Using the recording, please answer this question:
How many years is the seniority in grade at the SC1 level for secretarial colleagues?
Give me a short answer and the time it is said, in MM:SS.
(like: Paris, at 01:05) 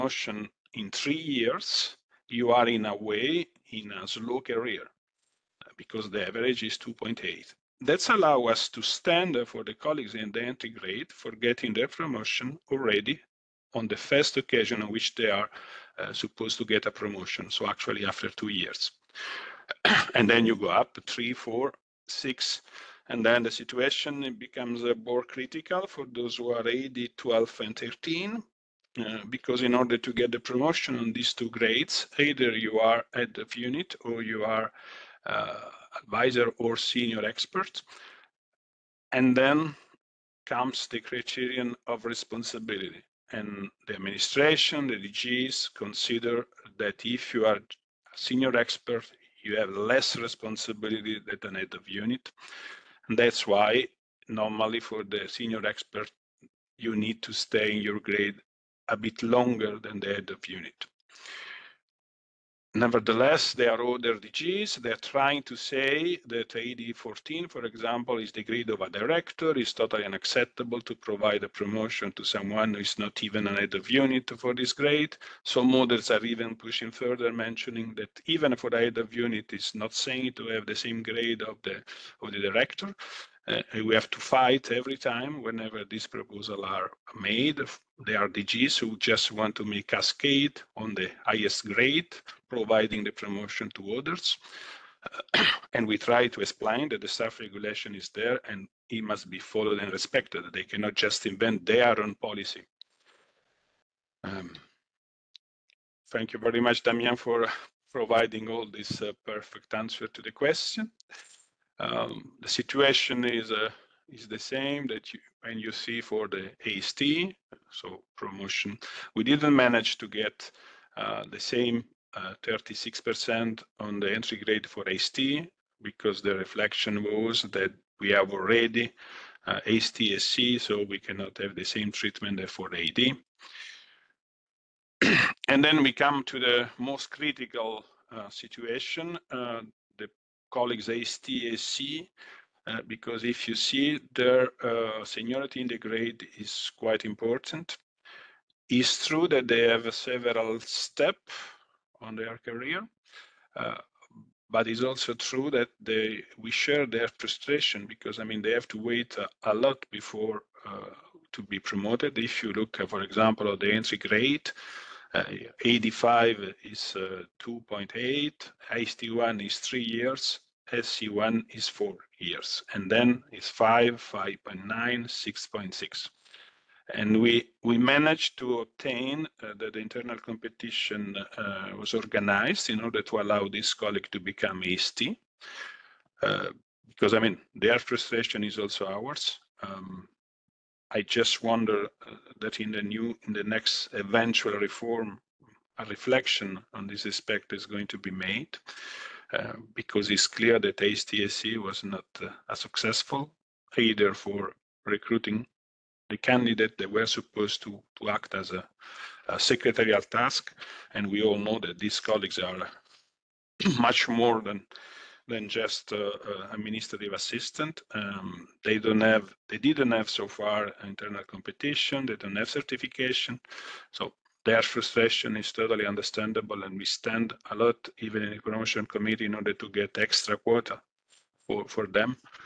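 4 years, at 02:51.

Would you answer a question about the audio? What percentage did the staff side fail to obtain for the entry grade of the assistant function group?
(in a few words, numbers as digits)
36%.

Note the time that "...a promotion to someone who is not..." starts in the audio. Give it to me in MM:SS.
01:11.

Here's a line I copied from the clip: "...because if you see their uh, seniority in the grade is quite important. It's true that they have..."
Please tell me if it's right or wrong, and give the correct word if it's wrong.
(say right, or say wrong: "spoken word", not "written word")
right.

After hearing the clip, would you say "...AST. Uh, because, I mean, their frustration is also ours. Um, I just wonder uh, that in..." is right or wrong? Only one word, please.
right.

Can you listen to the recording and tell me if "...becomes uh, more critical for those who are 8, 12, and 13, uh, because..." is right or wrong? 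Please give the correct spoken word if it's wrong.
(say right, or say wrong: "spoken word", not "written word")
right.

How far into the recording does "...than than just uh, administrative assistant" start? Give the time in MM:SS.
03:34.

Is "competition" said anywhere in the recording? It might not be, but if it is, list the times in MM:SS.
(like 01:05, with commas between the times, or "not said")
03:00, 03:41.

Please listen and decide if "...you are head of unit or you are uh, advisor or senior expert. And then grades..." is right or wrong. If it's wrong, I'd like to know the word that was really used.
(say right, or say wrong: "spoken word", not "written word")
wrong: "comes", not "grades".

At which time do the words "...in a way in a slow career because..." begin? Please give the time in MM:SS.
00:02.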